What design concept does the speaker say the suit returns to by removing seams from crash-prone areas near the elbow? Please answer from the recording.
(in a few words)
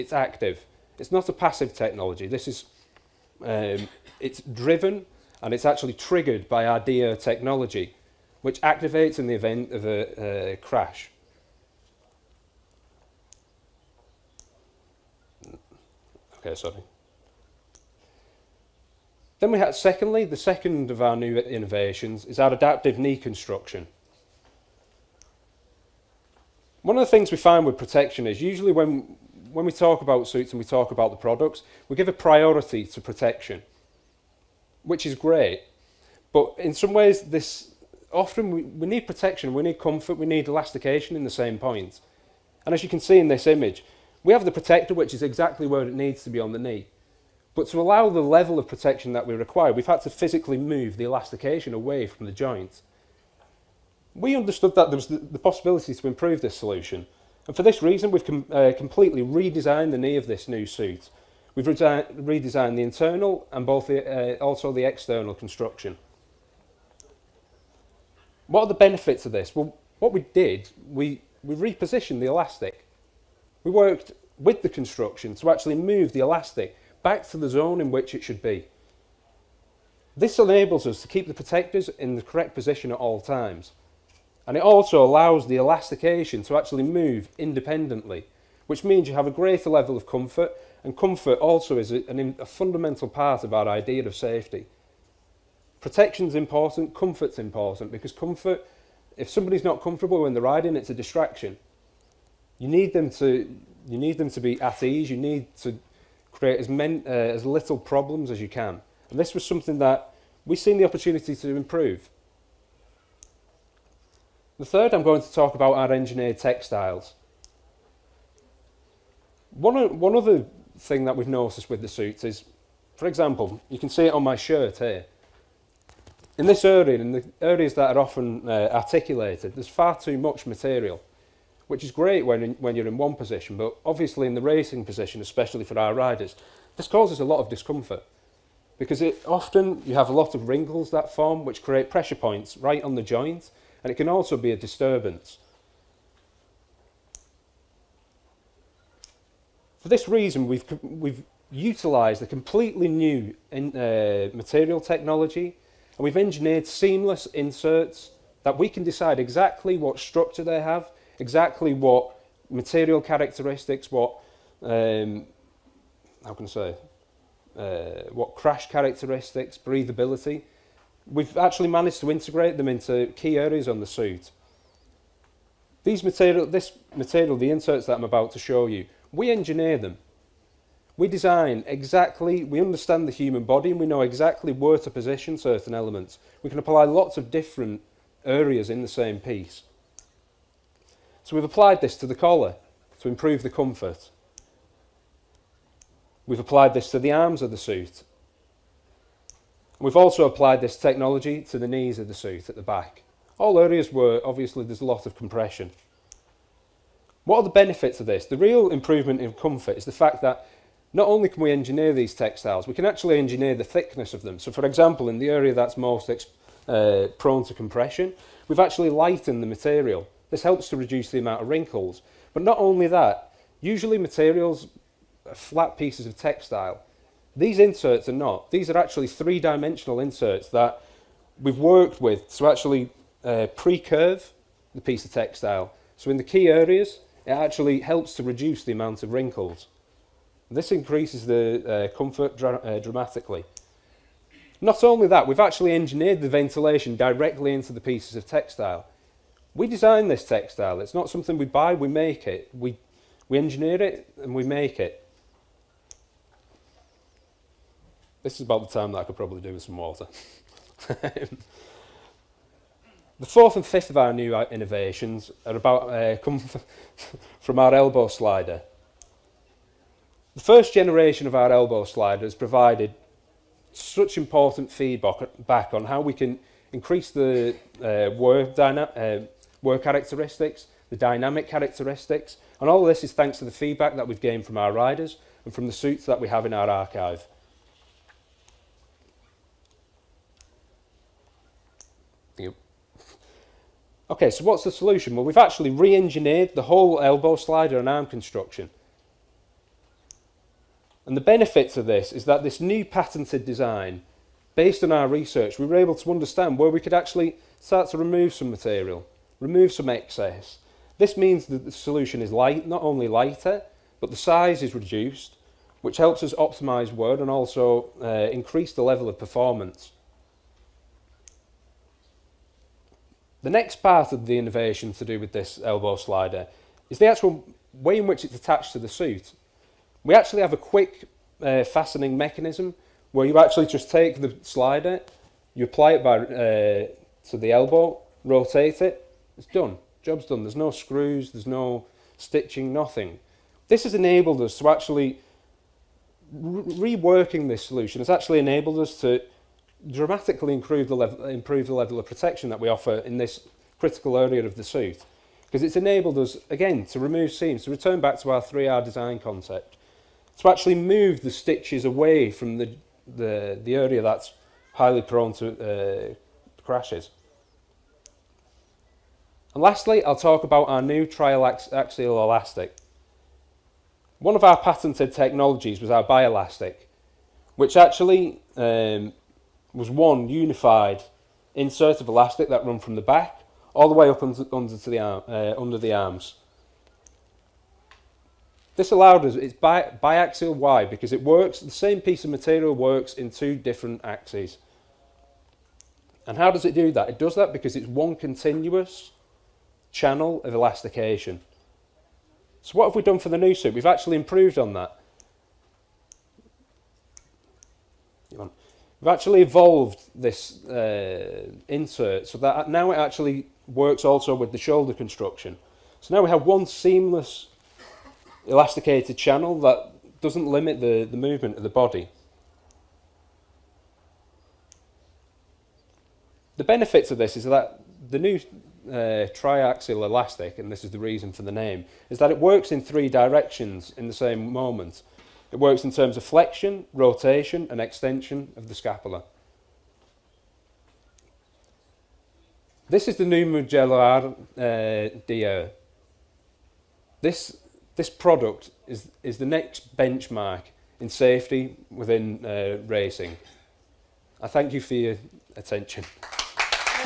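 3R design concept.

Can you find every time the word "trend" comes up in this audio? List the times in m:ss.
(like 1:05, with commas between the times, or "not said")
not said.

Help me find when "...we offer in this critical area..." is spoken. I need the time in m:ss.
5:52.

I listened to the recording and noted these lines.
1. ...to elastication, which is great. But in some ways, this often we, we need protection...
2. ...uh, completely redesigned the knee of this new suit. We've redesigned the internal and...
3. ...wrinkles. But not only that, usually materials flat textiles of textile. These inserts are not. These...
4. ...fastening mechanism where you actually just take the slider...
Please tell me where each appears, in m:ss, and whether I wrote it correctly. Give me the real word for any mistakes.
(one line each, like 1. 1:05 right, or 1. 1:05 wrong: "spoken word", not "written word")
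1. 0:32 wrong: "protection", not "elastication"
2. 0:58 right
3. 3:41 wrong: "pieces", not "textiles"
4. 5:31 right.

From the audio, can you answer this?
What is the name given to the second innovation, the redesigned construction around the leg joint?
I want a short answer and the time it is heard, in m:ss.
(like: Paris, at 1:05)
adaptive knee construction, at 0:22.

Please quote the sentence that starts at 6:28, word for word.
This allowed us, it's bi biaxial Y because it works, the same piece of material works in two different axes.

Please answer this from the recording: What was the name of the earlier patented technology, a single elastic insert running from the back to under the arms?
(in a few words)
bielastic.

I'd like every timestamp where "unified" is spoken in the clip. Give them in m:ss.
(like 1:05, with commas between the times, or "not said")
6:20.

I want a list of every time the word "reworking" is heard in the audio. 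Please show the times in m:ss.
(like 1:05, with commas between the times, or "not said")
5:46.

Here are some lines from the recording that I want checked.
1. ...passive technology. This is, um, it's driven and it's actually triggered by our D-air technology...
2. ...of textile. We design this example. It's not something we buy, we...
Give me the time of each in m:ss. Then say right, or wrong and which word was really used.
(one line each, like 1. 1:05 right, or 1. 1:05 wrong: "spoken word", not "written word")
1. 0:01 right
2. 4:08 wrong: "textile", not "example".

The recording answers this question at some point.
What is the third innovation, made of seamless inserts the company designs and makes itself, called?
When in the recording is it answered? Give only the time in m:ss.
1:55.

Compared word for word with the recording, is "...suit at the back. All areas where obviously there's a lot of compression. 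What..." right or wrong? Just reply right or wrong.
right.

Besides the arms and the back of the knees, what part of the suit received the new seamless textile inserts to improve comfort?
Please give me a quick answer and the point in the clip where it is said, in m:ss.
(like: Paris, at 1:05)
the collar, at 3:12.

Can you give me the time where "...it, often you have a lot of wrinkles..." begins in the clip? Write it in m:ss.
2:19.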